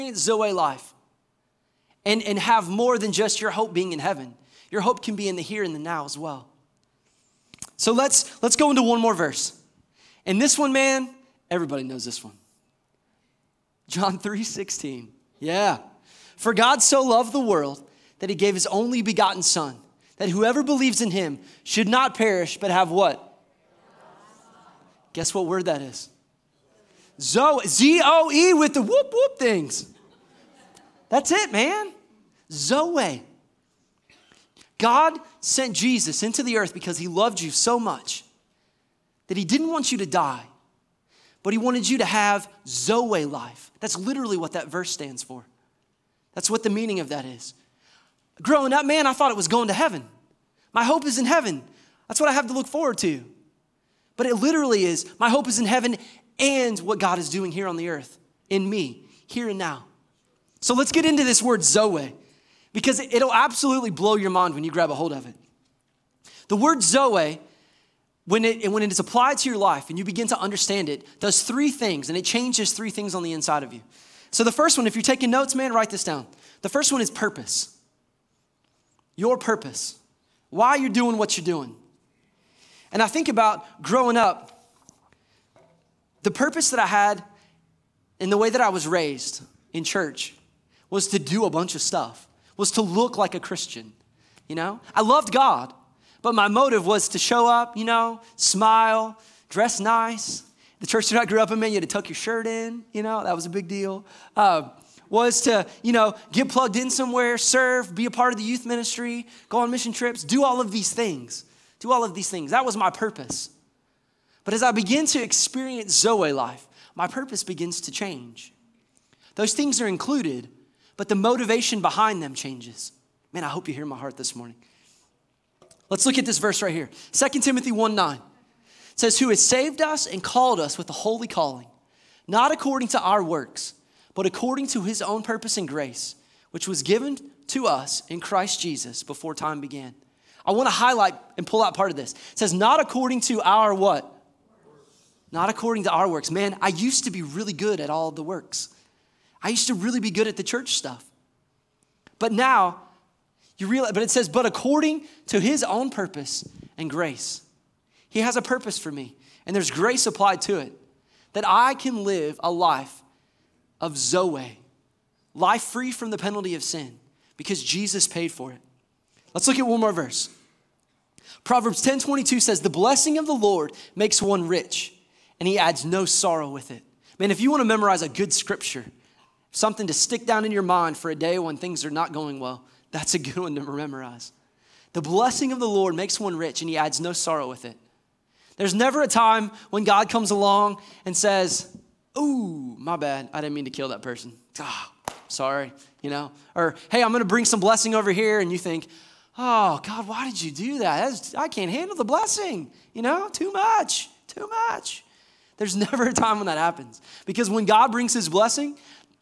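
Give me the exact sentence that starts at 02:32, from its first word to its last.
But now, you realize, but it says, but according to his own purpose and grace.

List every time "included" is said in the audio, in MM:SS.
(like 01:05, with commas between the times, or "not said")
01:59.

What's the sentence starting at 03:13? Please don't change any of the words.
I didn't mean to kill that person.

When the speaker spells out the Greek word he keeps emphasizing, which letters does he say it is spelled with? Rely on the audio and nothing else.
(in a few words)
Z O E.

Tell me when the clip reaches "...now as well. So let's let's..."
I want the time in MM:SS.
00:05.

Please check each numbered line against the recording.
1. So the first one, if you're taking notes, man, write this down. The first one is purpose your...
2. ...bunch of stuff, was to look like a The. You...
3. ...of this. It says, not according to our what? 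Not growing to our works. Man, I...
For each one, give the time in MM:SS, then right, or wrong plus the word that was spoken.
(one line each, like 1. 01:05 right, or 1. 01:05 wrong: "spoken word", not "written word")
1. 01:14 right
2. 01:31 wrong: "Christian", not "The"
3. 02:21 wrong: "according", not "growing".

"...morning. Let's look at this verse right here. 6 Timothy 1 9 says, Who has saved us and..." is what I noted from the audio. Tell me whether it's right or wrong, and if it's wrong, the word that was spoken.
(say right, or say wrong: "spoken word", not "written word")
wrong: "2", not "6".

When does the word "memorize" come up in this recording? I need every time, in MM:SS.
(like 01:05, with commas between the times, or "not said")
02:57, 03:03.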